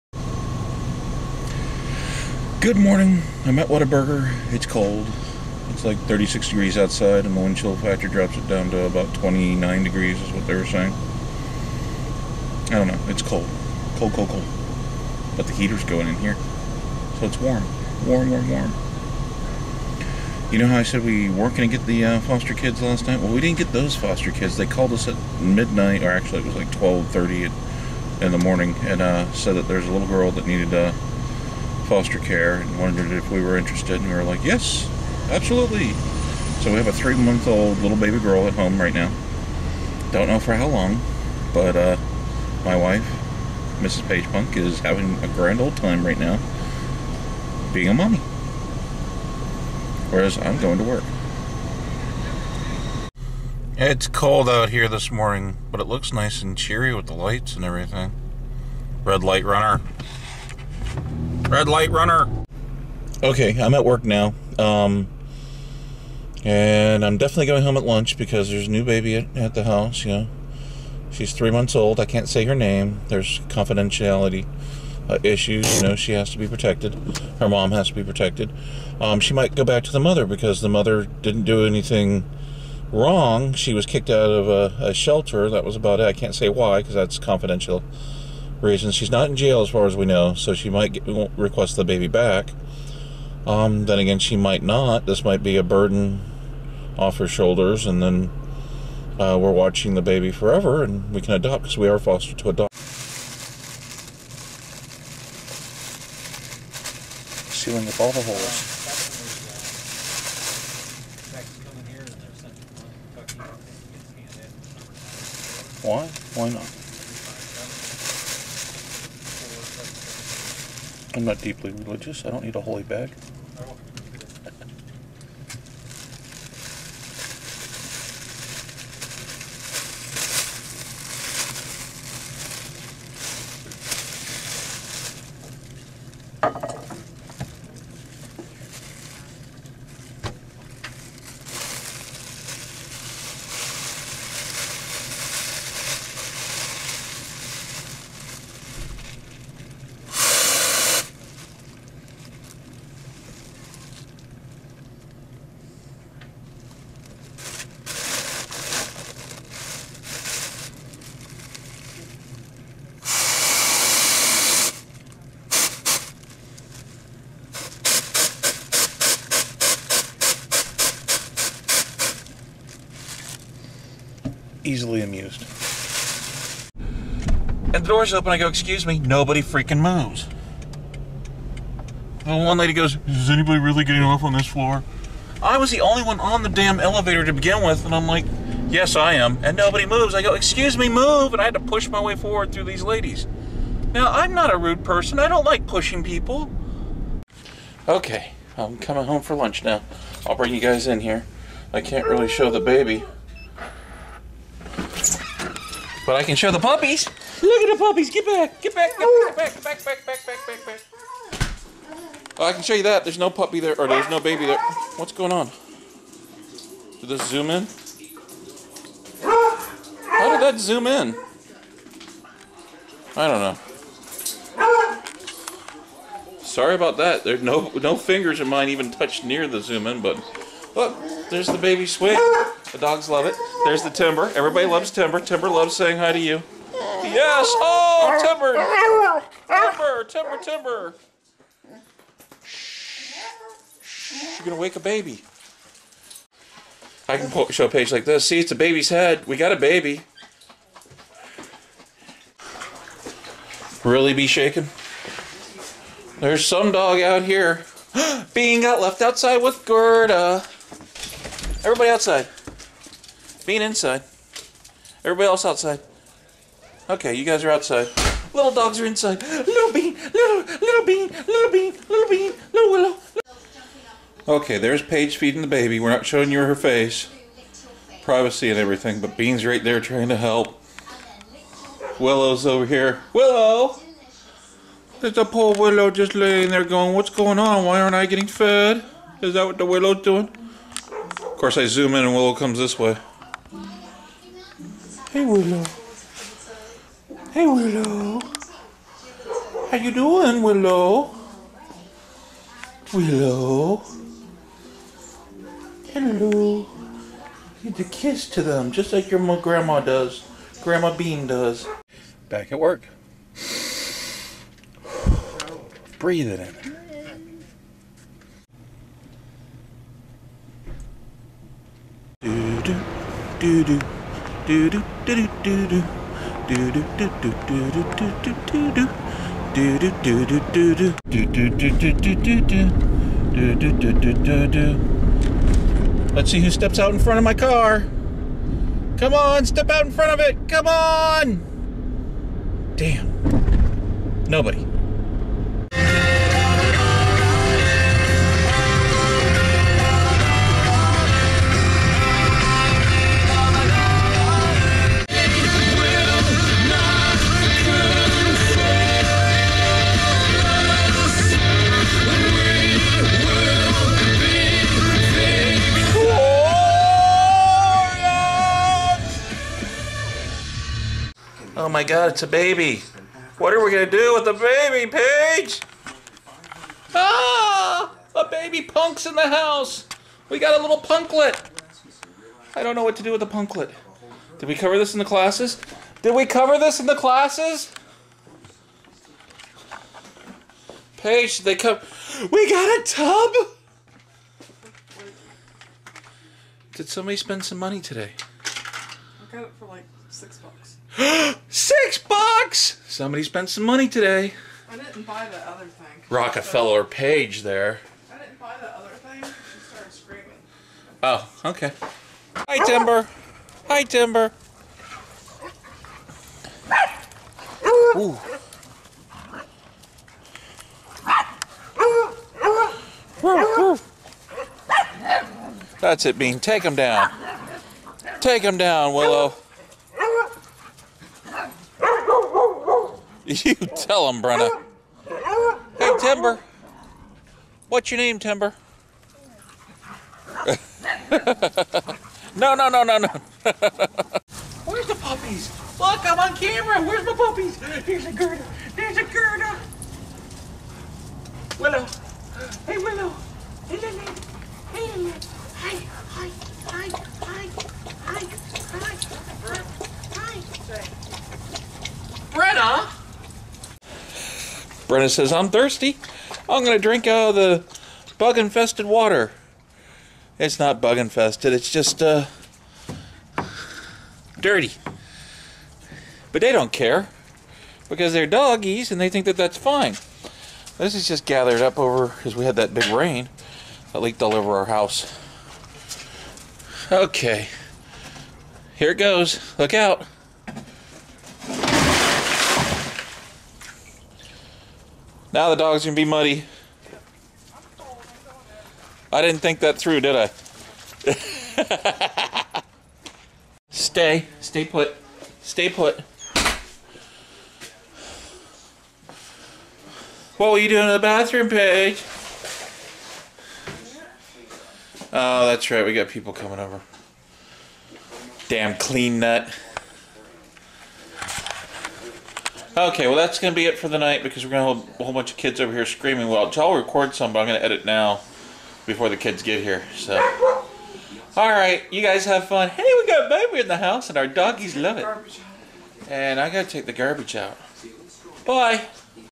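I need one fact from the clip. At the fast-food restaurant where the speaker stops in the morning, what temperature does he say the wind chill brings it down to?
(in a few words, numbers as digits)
29 degrees.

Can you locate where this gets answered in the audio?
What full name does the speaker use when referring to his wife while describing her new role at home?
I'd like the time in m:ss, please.
0:43.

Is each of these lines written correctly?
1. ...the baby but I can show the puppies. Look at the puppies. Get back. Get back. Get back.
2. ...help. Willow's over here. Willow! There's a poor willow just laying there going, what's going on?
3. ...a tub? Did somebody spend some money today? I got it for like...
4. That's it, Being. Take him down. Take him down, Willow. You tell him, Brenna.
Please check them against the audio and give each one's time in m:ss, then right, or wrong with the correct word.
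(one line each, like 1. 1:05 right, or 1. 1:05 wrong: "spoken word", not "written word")
1. 3:22 right
2. 4:40 right
3. 6:32 right
4. 7:05 wrong: "Bean", not "Being".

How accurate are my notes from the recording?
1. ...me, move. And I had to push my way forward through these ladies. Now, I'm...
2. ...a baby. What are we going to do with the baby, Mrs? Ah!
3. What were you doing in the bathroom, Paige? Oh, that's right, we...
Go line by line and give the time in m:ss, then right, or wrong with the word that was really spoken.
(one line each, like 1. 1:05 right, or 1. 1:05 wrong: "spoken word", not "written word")
1. 3:10 right
2. 6:12 wrong: "Paige", not "Mrs"
3. 8:30 right.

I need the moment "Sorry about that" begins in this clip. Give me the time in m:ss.
3:46.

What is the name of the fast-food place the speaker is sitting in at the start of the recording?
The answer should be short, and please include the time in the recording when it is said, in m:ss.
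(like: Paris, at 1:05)
Whataburger, at 0:03.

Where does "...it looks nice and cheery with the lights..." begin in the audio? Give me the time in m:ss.
0:55.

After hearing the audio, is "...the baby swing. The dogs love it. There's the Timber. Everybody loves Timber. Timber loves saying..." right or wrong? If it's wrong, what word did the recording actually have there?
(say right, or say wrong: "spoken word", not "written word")
right.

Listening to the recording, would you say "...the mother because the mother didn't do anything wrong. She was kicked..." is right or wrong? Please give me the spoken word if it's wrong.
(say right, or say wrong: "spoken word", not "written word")
right.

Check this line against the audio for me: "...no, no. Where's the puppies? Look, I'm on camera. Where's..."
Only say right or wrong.
right.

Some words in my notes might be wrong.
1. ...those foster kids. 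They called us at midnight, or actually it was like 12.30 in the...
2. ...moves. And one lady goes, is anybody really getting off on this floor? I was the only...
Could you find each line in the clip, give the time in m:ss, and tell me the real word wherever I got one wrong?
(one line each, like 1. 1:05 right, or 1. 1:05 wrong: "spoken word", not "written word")
1. 0:23 right
2. 2:59 right.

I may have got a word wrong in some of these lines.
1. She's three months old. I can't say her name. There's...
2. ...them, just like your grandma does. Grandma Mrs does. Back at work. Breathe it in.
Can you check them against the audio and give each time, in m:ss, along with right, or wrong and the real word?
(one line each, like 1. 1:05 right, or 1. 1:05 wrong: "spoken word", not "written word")
1. 1:11 right
2. 5:08 wrong: "Bean", not "Mrs".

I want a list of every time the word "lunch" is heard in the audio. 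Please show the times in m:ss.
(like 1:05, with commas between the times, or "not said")
1:07, 3:19.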